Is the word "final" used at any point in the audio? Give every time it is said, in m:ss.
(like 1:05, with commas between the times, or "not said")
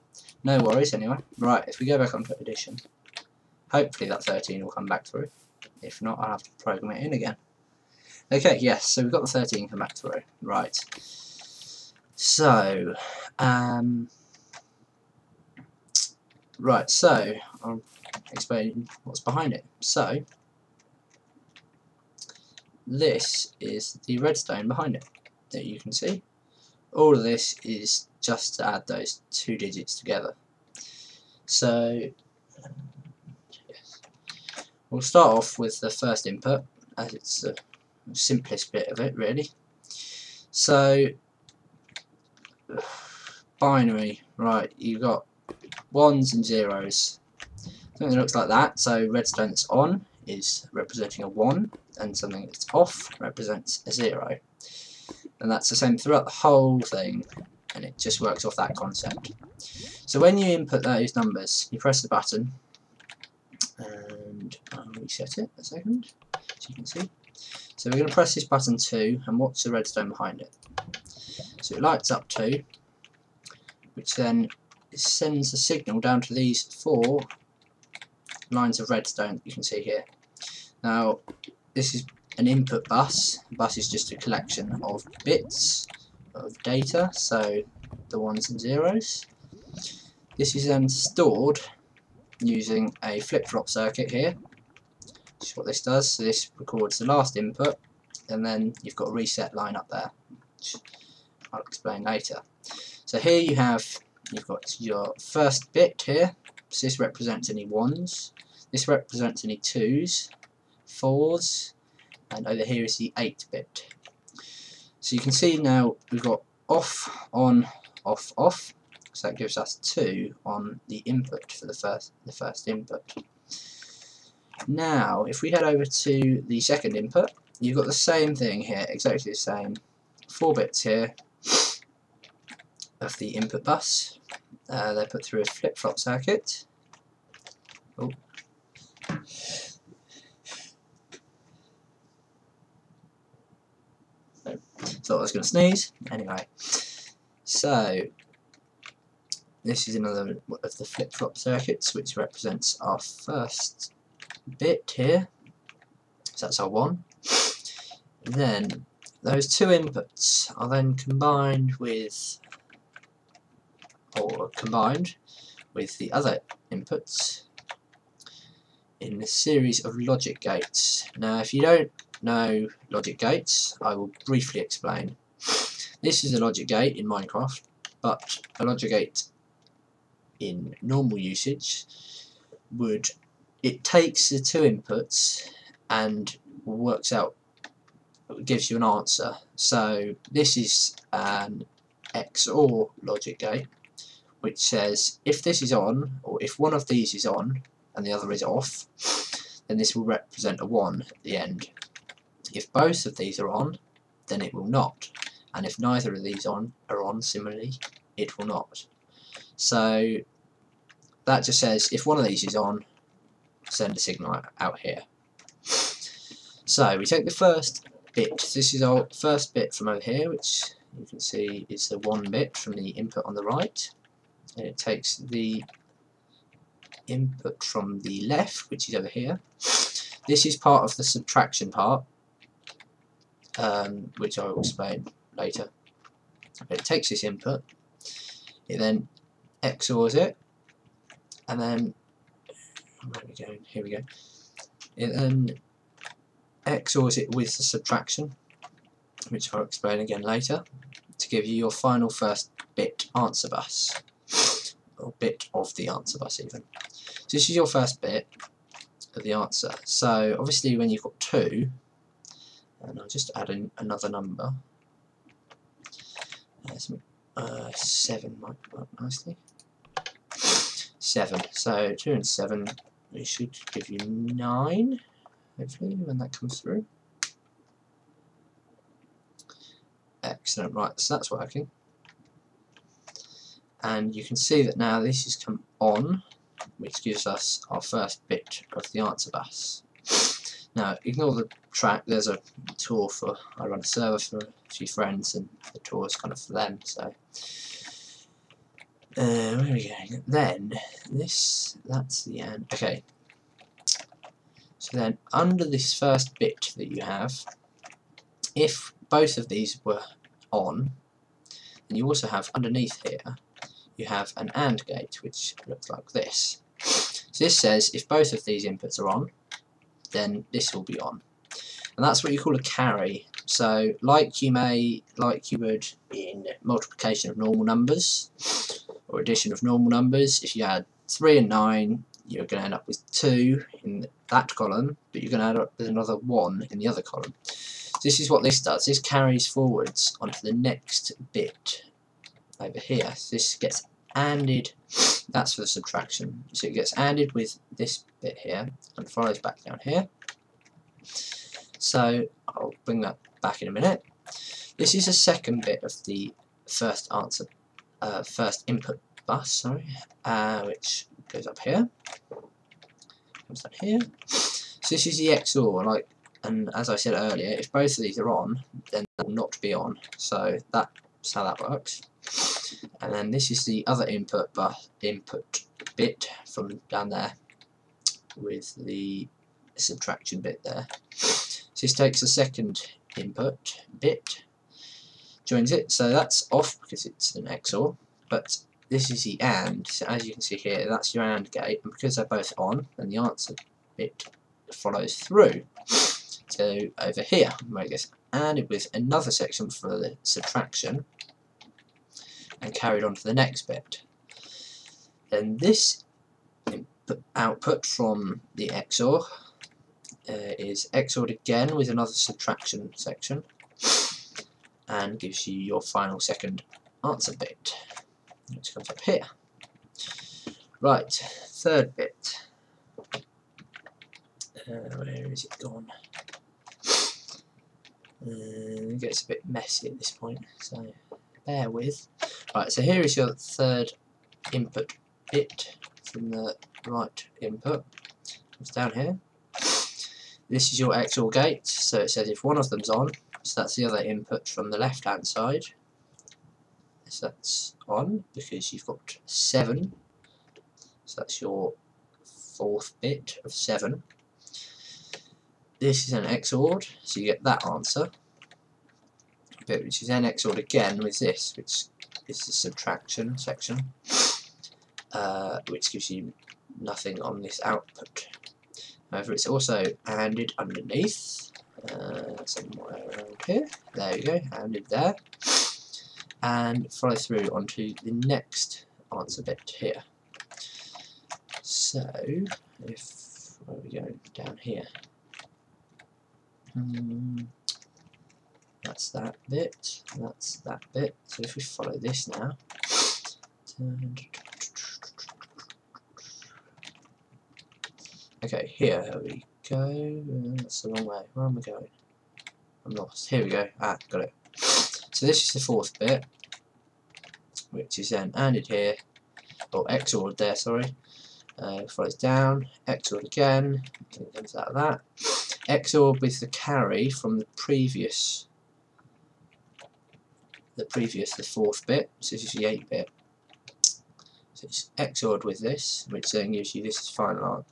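4:11, 6:55, 8:47.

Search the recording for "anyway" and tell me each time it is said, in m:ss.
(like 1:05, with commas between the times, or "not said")
0:00, 2:26.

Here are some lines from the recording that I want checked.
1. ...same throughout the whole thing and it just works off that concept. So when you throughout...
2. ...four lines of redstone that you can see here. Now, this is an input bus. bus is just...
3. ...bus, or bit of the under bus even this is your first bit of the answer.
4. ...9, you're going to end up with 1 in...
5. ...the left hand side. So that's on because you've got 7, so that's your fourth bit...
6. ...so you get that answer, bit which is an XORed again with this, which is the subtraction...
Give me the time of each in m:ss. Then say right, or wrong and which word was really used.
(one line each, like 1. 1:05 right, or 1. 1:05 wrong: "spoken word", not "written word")
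1. 0:55 wrong: "input", not "throughout"
2. 1:16 right
3. 4:13 wrong: "answer", not "under"
4. 5:31 wrong: "2", not "1"
5. 7:24 right
6. 7:37 right.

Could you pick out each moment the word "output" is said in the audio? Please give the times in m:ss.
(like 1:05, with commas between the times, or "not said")
6:47, 7:47.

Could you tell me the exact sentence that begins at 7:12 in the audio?
Right, so here is your third input bit from the right input.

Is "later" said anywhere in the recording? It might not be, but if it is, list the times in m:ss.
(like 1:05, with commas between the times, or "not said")
1:42, 3:55, 4:10.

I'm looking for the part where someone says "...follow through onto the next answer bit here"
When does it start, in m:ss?
7:56.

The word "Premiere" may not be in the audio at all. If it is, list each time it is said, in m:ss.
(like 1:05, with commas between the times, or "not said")
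not said.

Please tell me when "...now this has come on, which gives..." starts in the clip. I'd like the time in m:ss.
4:44.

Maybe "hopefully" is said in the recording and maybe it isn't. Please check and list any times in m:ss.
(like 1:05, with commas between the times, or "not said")
0:03, 4:35.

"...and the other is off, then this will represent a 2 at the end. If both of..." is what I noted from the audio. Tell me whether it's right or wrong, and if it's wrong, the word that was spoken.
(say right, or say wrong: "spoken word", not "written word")
wrong: "1", not "2".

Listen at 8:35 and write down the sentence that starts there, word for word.
XORed with the carry from the previous the previous, the fourth bit, so this is the 8 bit.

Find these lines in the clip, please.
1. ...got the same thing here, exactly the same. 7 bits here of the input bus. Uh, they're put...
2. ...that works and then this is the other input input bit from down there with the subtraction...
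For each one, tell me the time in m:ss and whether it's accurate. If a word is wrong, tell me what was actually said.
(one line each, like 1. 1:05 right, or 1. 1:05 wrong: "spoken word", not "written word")
1. 2:07 wrong: "4", not "7"
2. 6:11 right.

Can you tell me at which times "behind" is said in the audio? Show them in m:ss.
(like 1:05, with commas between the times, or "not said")
0:19, 0:24, 1:10.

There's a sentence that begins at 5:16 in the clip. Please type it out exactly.
So this says if both of these inputs are on, then this will be on.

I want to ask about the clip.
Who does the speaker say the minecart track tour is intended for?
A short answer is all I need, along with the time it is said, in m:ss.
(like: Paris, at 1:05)
a few friends, at 4:54.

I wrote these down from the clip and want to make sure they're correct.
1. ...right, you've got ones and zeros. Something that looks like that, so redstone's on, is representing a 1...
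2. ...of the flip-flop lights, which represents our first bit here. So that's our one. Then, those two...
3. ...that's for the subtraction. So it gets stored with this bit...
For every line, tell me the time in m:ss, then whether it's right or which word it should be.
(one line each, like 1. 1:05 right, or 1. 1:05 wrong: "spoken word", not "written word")
1. 0:44 right
2. 2:30 wrong: "circuits", not "lights"
3. 5:45 wrong: "anded", not "stored".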